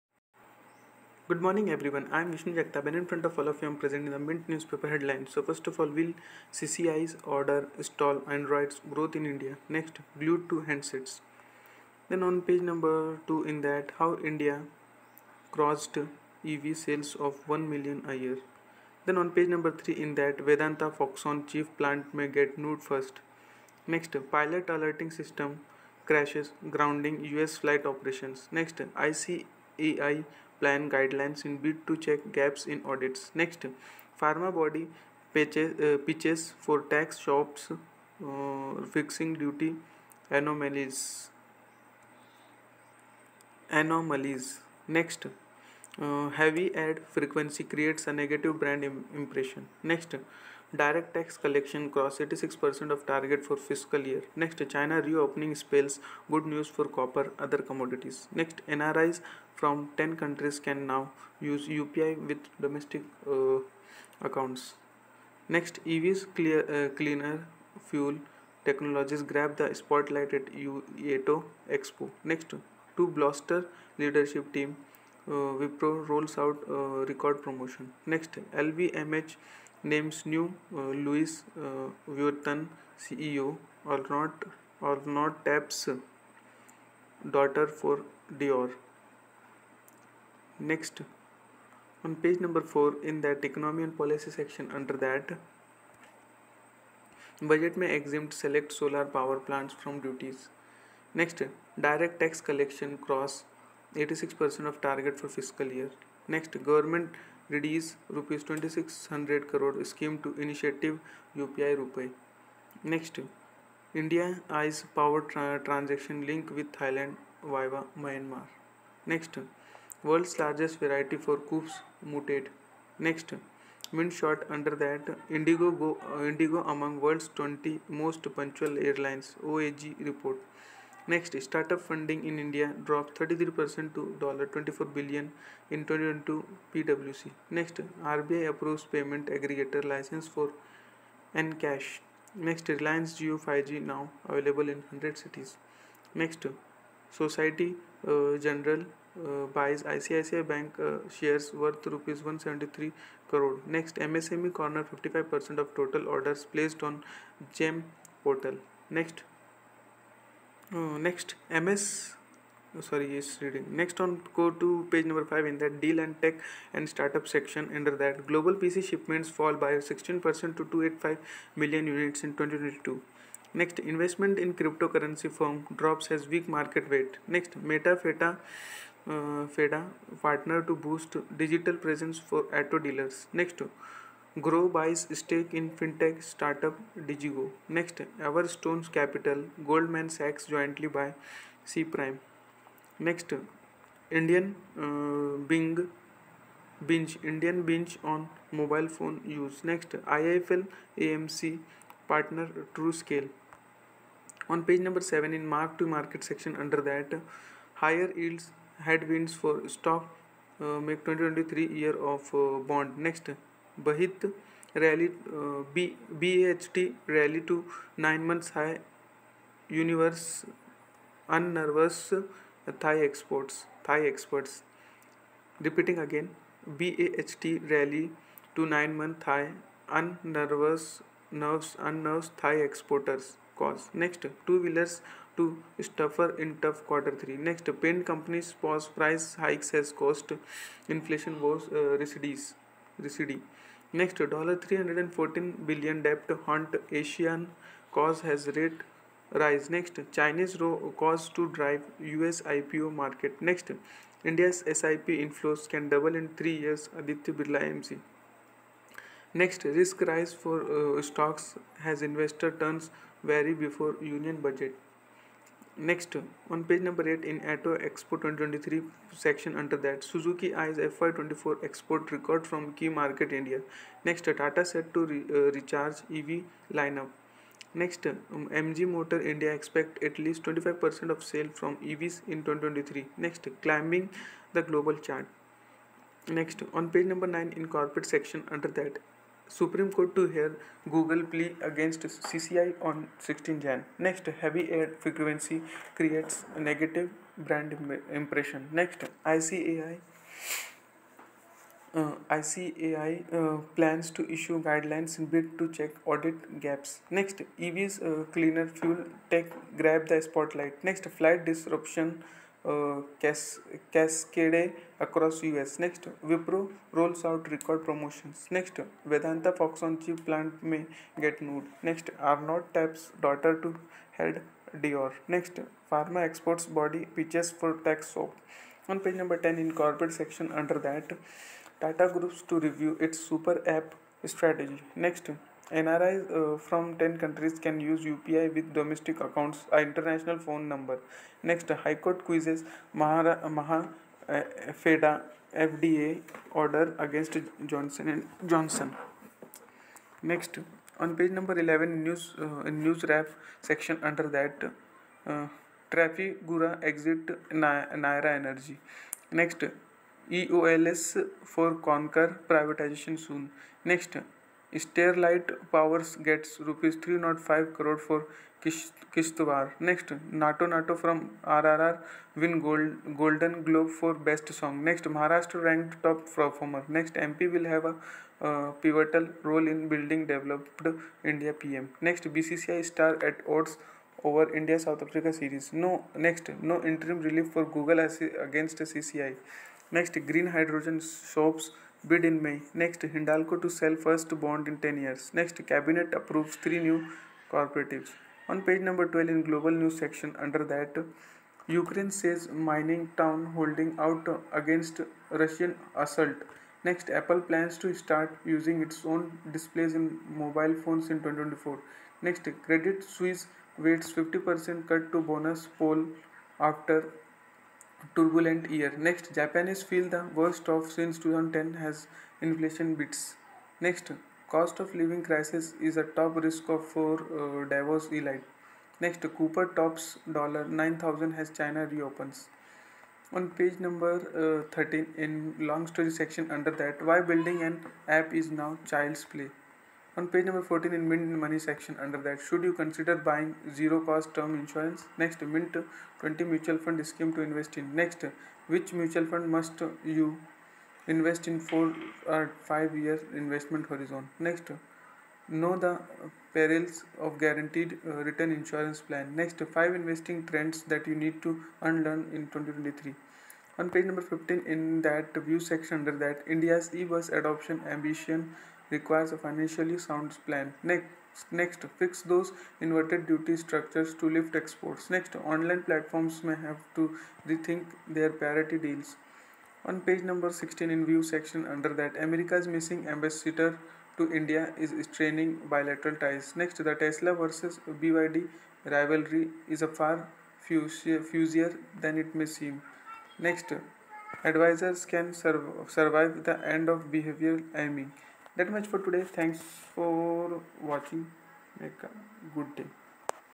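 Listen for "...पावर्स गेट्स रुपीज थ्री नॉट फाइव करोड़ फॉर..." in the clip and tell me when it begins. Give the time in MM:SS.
06:05.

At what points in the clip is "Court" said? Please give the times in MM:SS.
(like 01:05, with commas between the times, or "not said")
04:49, 05:41.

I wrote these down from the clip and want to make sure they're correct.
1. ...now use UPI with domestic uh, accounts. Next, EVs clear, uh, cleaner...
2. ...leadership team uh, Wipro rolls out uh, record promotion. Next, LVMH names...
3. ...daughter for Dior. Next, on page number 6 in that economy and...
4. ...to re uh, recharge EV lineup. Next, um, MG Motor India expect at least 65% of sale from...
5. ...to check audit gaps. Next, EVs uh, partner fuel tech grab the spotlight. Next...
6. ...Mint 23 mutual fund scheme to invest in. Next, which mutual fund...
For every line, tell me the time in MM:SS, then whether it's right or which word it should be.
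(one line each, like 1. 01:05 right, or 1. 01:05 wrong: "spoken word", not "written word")
1. 01:00 right
2. 01:13 right
3. 01:27 wrong: "4", not "6"
4. 04:34 wrong: "25", not "65"
5. 05:05 wrong: "cleaner", not "partner"
6. 07:25 wrong: "20", not "23".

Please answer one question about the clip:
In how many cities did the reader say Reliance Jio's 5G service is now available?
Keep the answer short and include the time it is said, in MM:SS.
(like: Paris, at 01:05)
100, at 02:24.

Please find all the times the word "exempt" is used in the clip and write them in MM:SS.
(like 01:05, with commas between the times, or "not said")
01:37.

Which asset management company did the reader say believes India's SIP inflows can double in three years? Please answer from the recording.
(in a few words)
Aditya Birla AMC.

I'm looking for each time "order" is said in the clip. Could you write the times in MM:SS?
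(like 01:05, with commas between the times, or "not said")
00:07, 02:36, 05:46.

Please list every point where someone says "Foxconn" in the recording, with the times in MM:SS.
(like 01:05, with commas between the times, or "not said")
00:20, 05:19.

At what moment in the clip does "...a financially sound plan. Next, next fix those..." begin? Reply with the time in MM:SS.
07:49.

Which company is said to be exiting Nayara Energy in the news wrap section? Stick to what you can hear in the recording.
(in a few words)
Trafigura.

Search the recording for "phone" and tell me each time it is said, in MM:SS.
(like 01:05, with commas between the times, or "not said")
03:18, 05:40, 06:50.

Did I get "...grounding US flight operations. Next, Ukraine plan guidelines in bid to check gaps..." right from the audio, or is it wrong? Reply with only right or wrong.
wrong.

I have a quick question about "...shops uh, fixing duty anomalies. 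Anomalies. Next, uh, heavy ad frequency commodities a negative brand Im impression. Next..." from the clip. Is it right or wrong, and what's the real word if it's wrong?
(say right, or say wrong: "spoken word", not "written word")
wrong: "creates", not "commodities".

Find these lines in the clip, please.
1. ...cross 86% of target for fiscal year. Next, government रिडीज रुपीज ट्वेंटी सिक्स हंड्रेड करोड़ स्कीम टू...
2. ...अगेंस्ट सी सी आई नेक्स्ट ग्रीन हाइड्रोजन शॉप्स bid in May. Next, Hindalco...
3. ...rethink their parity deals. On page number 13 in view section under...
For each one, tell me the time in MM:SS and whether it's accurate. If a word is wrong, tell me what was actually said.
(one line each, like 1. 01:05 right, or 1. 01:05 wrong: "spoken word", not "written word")
1. 01:42 right
2. 06:28 right
3. 07:57 wrong: "16", not "13".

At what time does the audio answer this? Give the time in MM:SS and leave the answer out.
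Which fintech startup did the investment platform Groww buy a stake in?
03:06.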